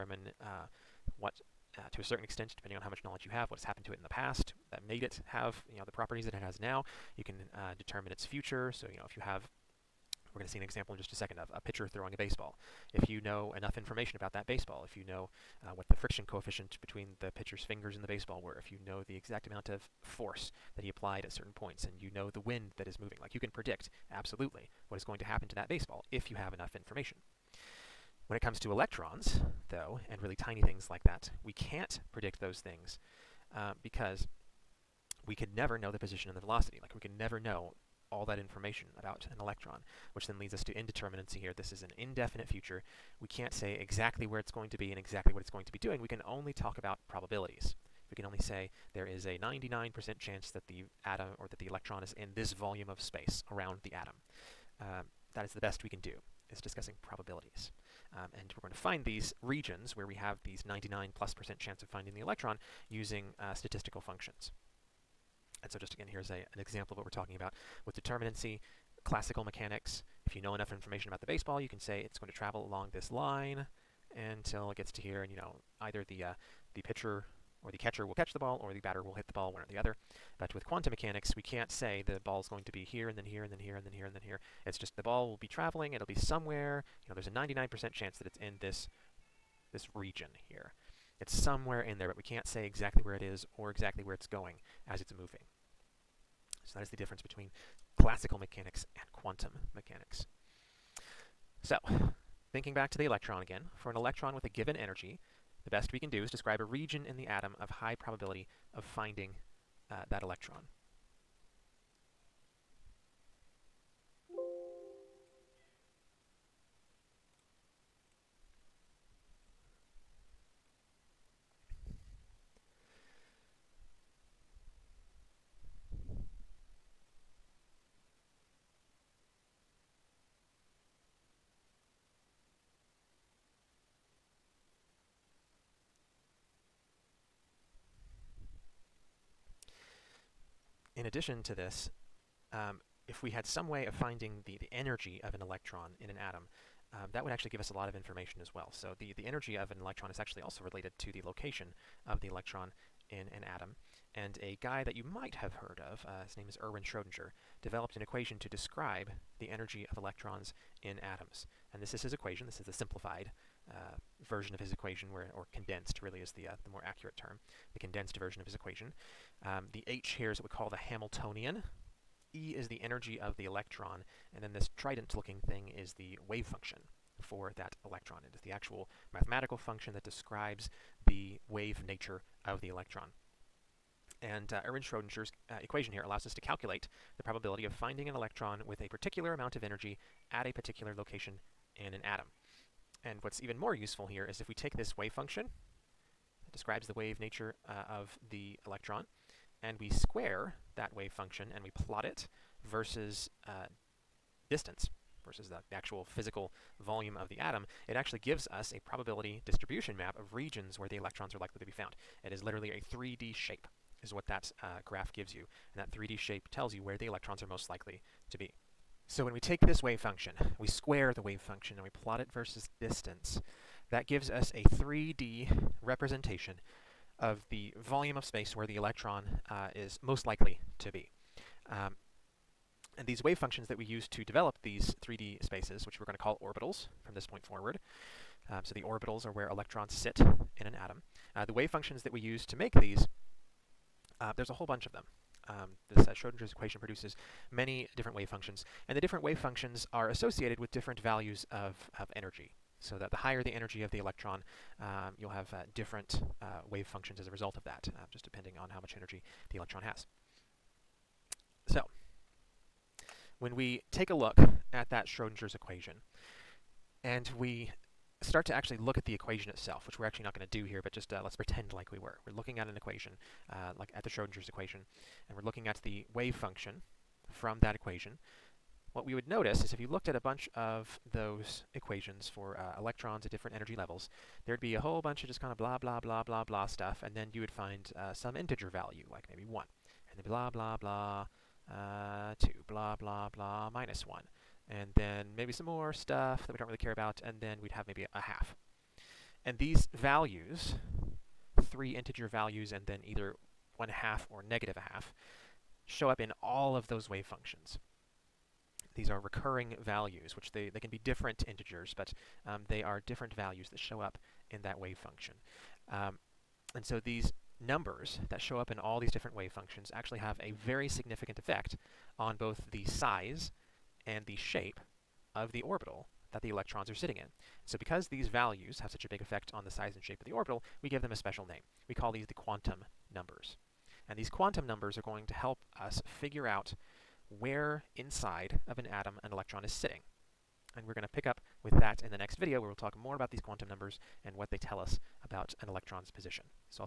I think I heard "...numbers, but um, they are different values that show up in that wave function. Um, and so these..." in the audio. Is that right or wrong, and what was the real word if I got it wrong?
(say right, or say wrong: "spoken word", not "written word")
wrong: "integers", not "numbers".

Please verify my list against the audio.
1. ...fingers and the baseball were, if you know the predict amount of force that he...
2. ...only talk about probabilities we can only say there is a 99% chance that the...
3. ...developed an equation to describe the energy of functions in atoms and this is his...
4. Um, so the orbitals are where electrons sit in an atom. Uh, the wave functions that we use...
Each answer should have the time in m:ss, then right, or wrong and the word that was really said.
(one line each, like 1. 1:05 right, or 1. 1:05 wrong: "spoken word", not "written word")
1. 0:17 wrong: "exact", not "predict"
2. 0:46 right
3. 2:37 wrong: "electrons", not "functions"
4. 3:58 right.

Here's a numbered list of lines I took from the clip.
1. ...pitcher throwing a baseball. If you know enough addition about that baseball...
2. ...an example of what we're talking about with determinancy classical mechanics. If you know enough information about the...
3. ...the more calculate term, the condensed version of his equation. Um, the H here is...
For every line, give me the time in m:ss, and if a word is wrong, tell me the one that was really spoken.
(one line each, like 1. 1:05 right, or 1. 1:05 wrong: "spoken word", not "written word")
1. 0:11 wrong: "information", not "addition"
2. 1:06 right
3. 2:46 wrong: "accurate", not "calculate".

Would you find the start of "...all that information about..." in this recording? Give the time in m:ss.
0:38.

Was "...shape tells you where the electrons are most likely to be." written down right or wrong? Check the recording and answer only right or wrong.
right.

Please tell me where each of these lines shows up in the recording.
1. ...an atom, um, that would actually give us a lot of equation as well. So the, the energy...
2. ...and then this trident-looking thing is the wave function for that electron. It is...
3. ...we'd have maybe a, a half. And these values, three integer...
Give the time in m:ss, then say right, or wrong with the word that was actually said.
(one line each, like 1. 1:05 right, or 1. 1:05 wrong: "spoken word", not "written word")
1. 2:26 wrong: "information", not "equation"
2. 2:54 right
3. 4:57 right.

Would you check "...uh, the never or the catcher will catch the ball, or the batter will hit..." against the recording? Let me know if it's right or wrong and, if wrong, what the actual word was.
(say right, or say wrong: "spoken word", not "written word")
wrong: "pitcher", not "never".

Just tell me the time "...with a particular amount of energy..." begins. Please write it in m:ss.
3:08.